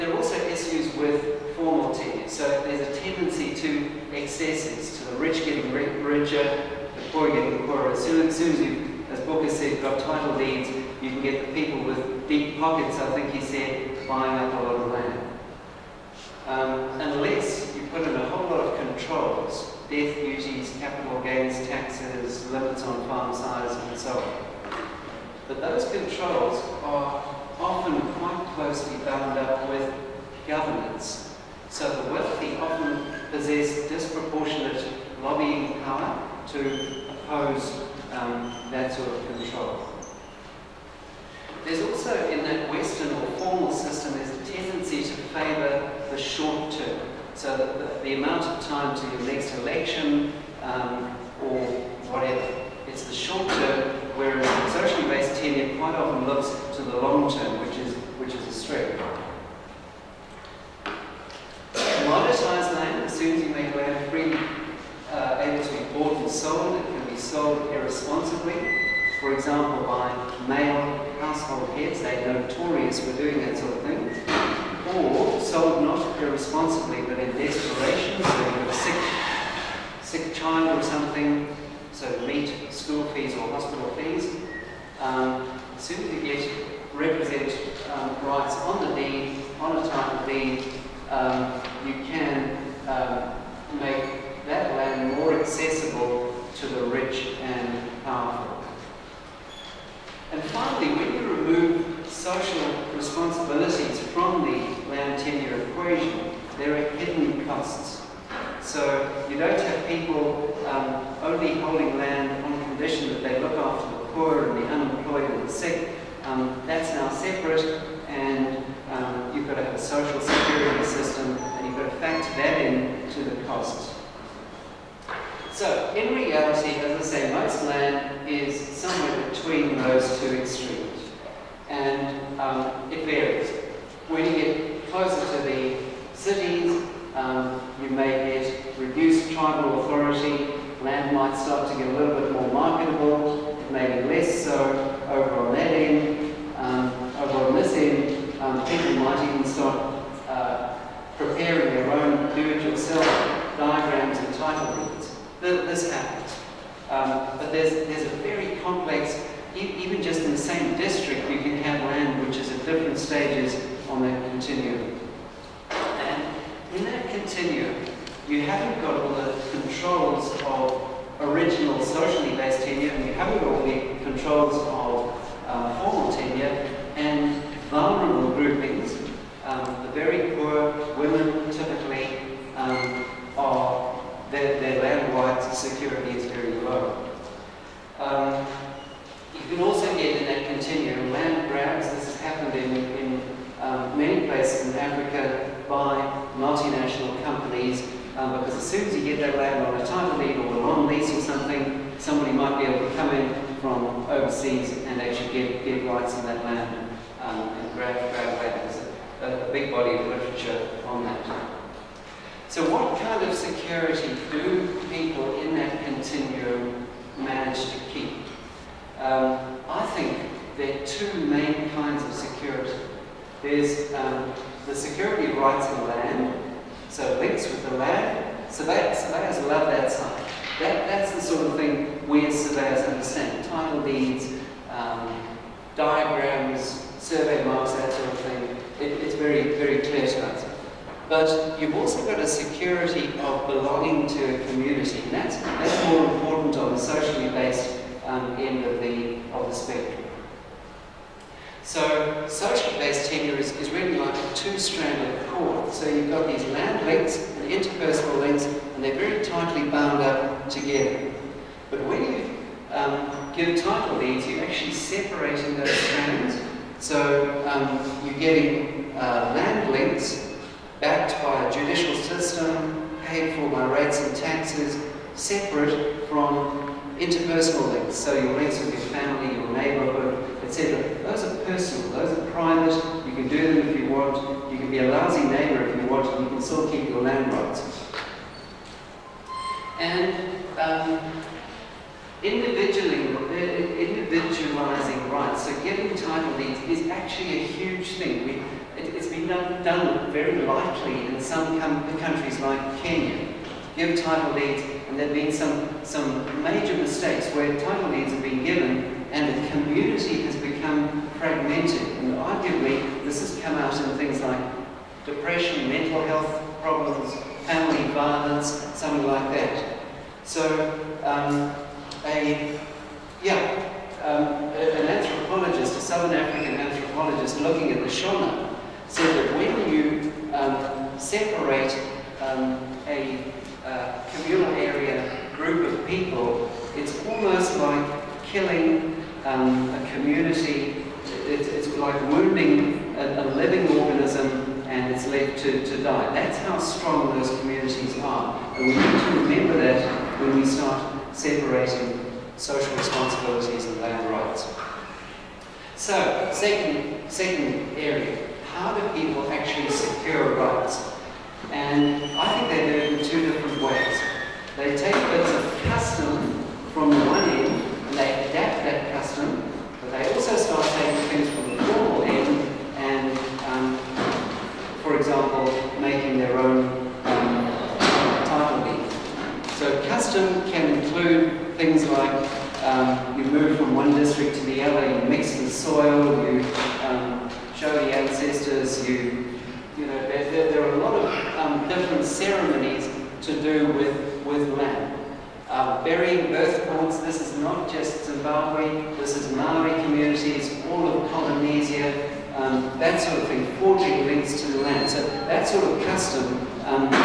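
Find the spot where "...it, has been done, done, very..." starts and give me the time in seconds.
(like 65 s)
298 s.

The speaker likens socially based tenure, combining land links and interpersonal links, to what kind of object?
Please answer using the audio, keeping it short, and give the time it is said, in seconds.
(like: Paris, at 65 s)
a two-stranded cord, at 254 s.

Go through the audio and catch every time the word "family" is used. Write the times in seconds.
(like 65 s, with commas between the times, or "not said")
278 s, 317 s.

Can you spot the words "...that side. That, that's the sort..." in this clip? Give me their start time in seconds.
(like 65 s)
229 s.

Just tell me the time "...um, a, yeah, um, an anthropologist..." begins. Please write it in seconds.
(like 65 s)
321 s.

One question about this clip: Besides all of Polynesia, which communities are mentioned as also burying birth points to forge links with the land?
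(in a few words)
Maori communities.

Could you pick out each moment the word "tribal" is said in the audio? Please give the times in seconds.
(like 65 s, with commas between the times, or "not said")
139 s.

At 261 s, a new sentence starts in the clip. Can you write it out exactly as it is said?
But when you um, get title there to actually separating those strands.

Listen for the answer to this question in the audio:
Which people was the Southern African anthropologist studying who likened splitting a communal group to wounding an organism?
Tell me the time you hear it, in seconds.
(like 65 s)
327 s.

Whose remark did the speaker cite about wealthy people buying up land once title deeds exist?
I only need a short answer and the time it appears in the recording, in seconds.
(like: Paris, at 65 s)
Booker, at 9 s.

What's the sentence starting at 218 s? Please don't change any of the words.
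Um, I think there are two main kinds of security.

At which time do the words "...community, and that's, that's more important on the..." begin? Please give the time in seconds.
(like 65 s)
244 s.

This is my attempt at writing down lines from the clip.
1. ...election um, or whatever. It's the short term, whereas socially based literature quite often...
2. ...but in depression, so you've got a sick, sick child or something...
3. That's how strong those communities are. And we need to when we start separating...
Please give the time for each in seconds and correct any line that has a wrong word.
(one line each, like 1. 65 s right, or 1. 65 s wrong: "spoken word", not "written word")
1. 49 s wrong: "tenure", not "literature"
2. 77 s wrong: "desperation", not "depression"
3. 346 s right.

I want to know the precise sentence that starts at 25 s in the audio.
But those controls are often quite closely bound up with governance.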